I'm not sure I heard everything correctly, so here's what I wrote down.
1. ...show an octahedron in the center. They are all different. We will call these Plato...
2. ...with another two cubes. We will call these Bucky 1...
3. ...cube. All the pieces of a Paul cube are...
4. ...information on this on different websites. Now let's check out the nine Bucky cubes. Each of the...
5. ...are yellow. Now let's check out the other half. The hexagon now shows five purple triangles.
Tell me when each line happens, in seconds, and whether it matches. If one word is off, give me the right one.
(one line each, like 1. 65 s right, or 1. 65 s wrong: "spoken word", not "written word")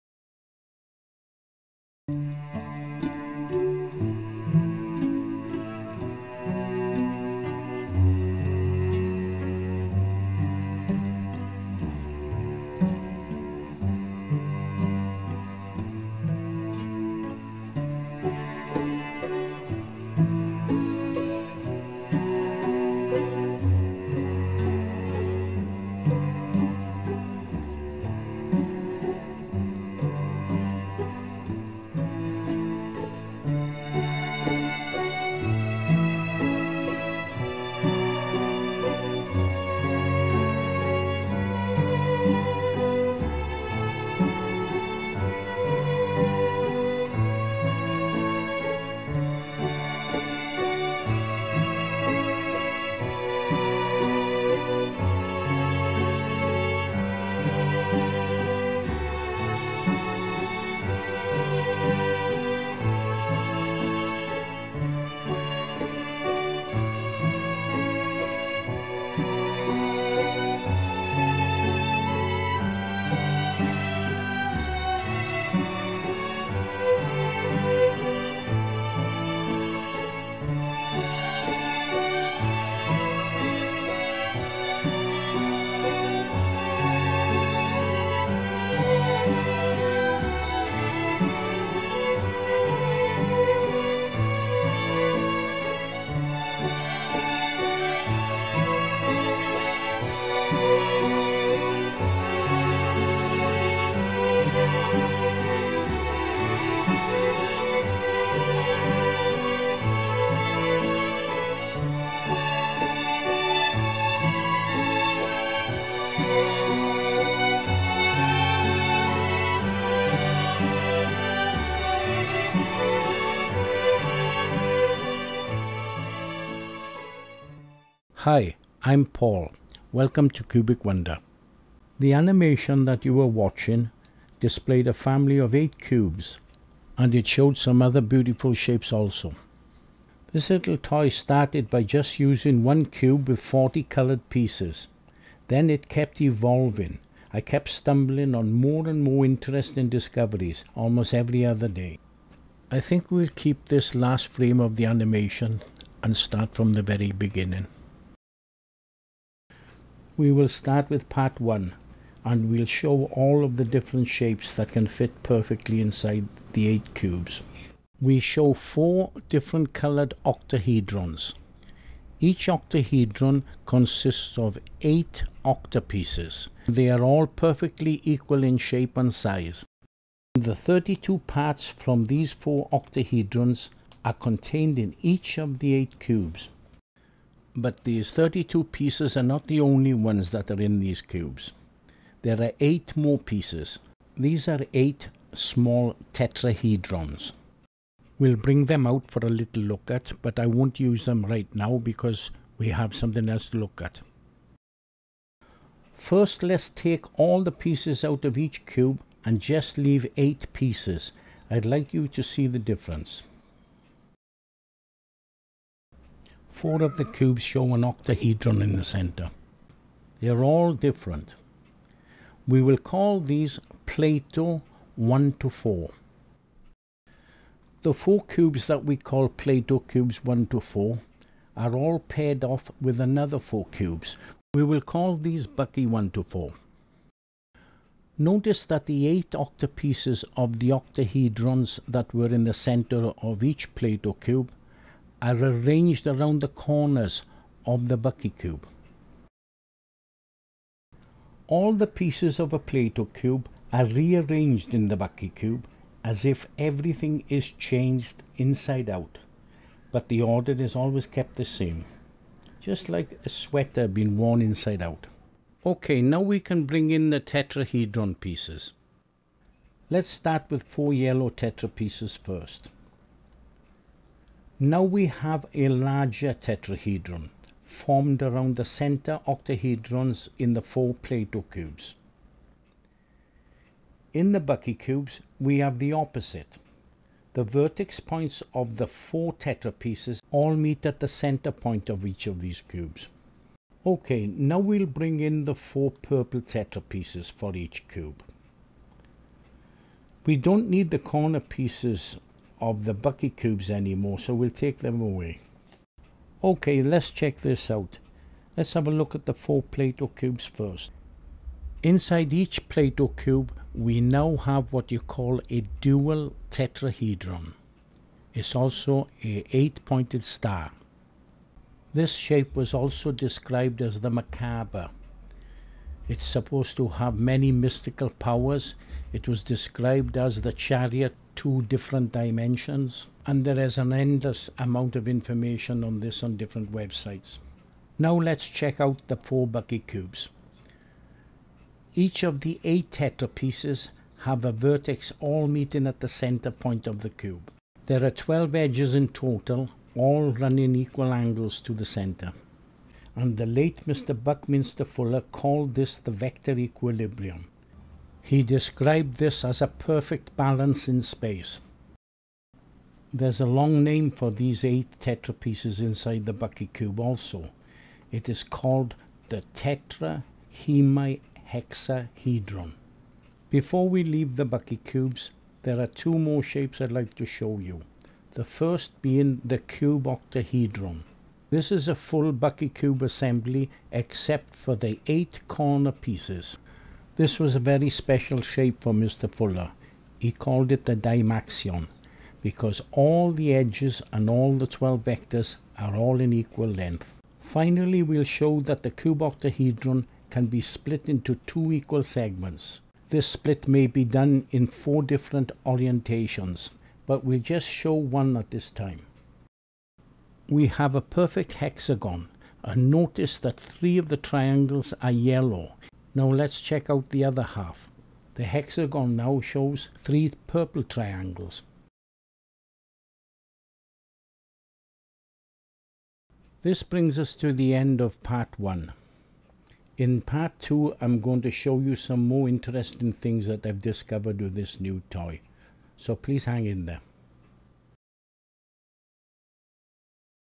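1. 217 s right
2. 232 s wrong: "four", not "two"
3. 248 s wrong: "Plato", not "Paul"
4. 335 s wrong: "four", not "nine"
5. 415 s wrong: "three", not "five".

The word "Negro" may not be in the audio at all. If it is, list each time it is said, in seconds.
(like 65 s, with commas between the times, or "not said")
not said.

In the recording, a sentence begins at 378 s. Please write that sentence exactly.
The first being the cube octahedron.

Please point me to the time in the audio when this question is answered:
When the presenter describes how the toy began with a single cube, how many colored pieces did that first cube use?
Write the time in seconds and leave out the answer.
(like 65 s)
143 s.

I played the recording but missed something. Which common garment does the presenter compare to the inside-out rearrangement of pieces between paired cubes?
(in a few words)
A sweater.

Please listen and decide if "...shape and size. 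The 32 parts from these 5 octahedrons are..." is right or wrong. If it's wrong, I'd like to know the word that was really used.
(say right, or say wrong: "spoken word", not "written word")
wrong: "4", not "5".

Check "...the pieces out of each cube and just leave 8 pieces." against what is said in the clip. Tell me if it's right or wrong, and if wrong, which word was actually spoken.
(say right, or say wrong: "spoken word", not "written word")
right.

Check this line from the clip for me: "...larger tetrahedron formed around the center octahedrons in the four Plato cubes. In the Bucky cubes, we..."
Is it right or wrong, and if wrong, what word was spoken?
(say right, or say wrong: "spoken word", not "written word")
right.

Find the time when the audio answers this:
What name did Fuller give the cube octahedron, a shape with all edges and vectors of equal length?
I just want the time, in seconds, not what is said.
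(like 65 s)
390 s.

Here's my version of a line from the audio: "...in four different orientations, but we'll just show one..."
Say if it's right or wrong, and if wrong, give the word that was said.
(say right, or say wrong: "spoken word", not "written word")
right.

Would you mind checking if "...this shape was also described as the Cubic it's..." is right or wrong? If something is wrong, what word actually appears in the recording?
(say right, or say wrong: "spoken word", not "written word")
wrong: "Merkaba", not "Cubic".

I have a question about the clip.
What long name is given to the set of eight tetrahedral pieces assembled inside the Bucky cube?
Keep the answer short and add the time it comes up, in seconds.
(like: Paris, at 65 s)
Tetrahemihexahedron, at 369 s.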